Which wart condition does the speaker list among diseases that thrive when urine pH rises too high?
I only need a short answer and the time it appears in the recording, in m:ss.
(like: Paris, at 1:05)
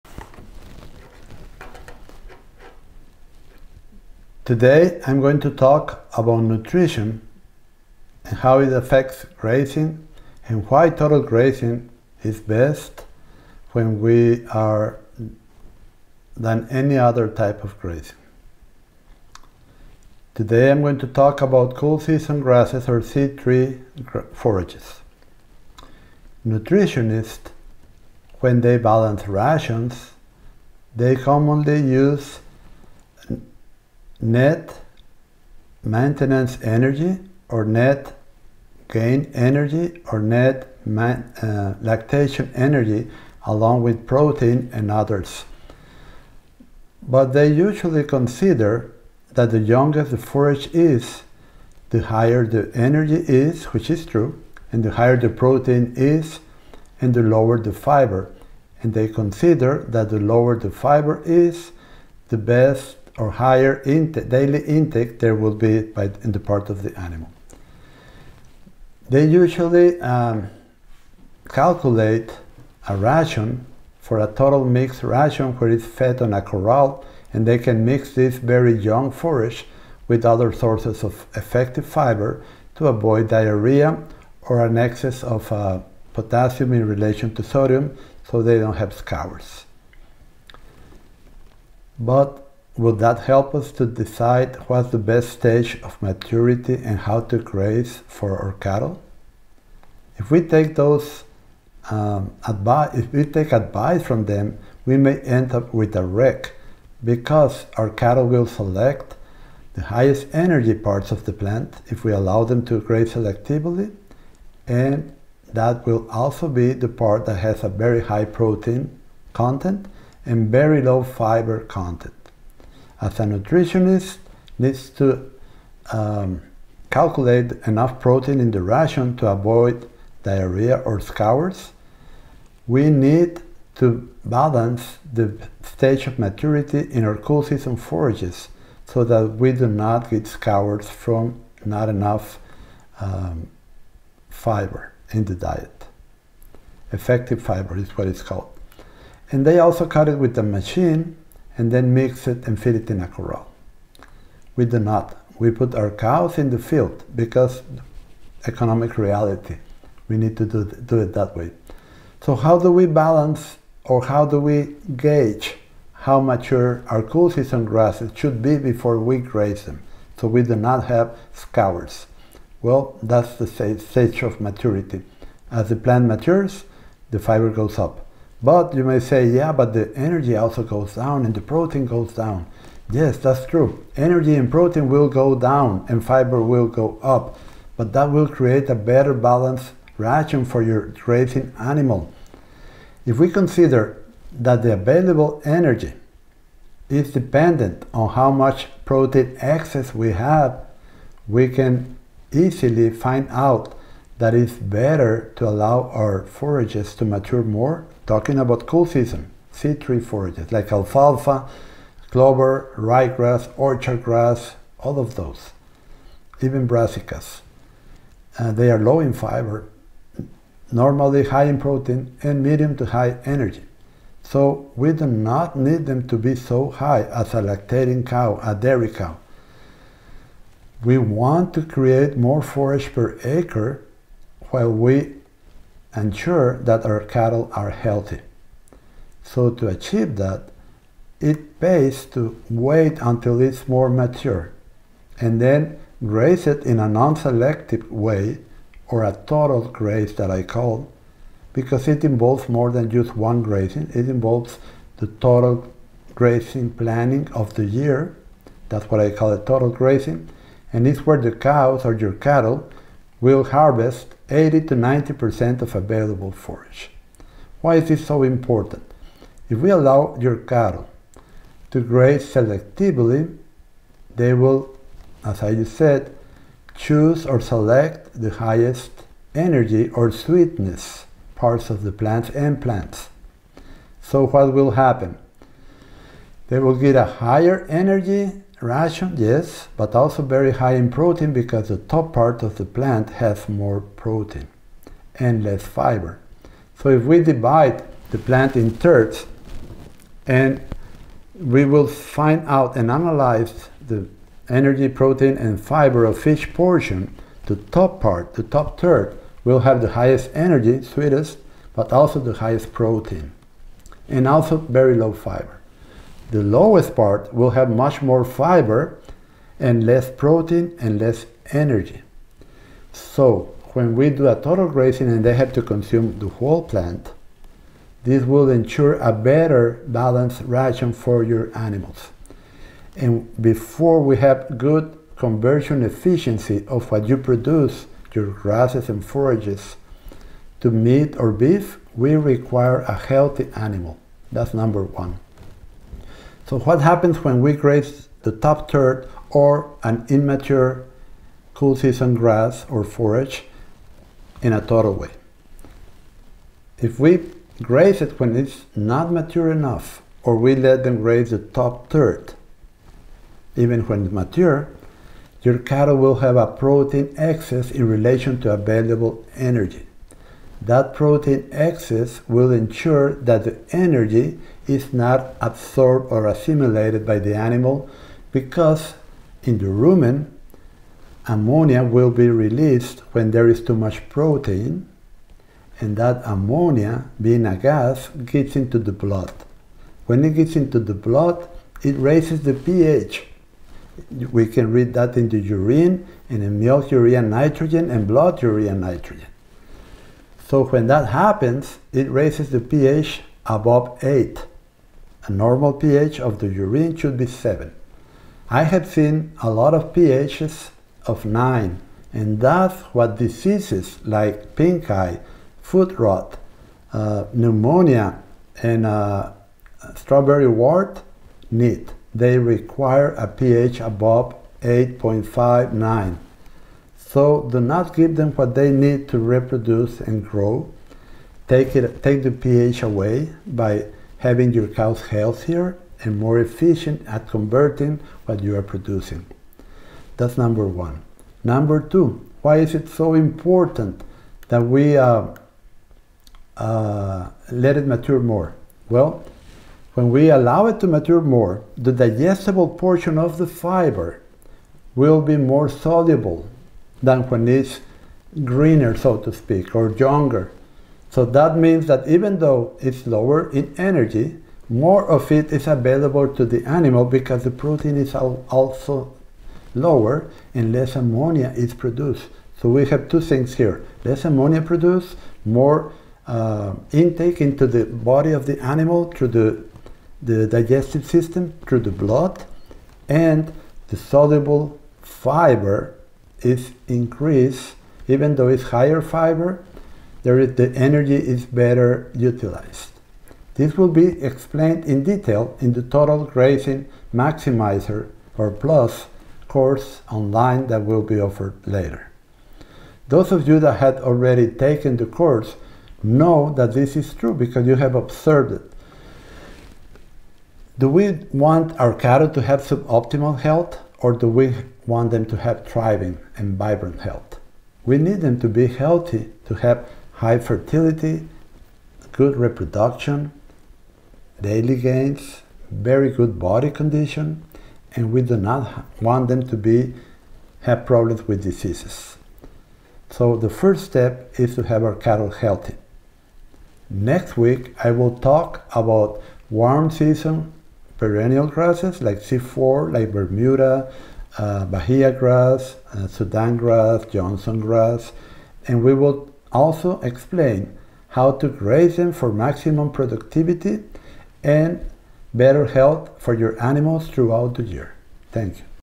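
Strawberry wart, at 6:59.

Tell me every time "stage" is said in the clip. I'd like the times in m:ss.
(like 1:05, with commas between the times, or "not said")
1:35, 2:15, 2:53.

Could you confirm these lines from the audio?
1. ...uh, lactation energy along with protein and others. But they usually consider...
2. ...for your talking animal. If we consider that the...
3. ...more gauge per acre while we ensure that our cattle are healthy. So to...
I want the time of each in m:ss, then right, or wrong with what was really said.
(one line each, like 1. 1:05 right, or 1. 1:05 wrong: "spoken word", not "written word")
1. 0:41 right
2. 3:10 wrong: "grazing", not "talking"
3. 3:52 wrong: "forage", not "gauge".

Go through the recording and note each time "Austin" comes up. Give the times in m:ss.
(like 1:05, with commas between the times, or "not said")
not said.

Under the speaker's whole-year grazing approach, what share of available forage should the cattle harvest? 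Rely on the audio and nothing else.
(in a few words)
80 to 90%.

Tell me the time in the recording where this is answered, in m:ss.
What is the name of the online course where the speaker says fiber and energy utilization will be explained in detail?
8:15.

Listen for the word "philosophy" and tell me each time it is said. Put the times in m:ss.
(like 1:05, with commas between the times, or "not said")
not said.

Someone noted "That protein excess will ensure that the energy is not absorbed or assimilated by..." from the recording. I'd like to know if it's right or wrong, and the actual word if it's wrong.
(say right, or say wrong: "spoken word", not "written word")
right.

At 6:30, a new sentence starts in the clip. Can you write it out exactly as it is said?
When it gets into the blood, it raises the pH.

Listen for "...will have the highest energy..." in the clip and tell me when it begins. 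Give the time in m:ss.
5:09.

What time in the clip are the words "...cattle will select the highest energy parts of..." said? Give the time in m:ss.
1:47.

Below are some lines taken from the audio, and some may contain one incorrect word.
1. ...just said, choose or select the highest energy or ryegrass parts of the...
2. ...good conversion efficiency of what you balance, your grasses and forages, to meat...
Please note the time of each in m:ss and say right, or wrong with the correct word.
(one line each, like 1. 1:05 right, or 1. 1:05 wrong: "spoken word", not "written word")
1. 4:35 wrong: "sweetness", not "ryegrass"
2. 5:34 wrong: "produce", not "balance".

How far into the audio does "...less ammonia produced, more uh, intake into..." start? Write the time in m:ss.
7:54.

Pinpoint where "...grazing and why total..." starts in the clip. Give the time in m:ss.
0:09.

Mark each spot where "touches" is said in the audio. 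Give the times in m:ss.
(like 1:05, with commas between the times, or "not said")
not said.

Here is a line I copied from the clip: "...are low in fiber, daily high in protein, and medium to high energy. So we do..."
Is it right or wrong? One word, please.
wrong.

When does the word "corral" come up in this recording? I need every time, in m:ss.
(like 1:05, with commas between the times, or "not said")
1:16, 2:33.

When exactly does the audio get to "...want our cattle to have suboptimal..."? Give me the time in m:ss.
8:31.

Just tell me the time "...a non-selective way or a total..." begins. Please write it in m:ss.
4:06.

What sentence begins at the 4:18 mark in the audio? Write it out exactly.
That's what I call a total grazing.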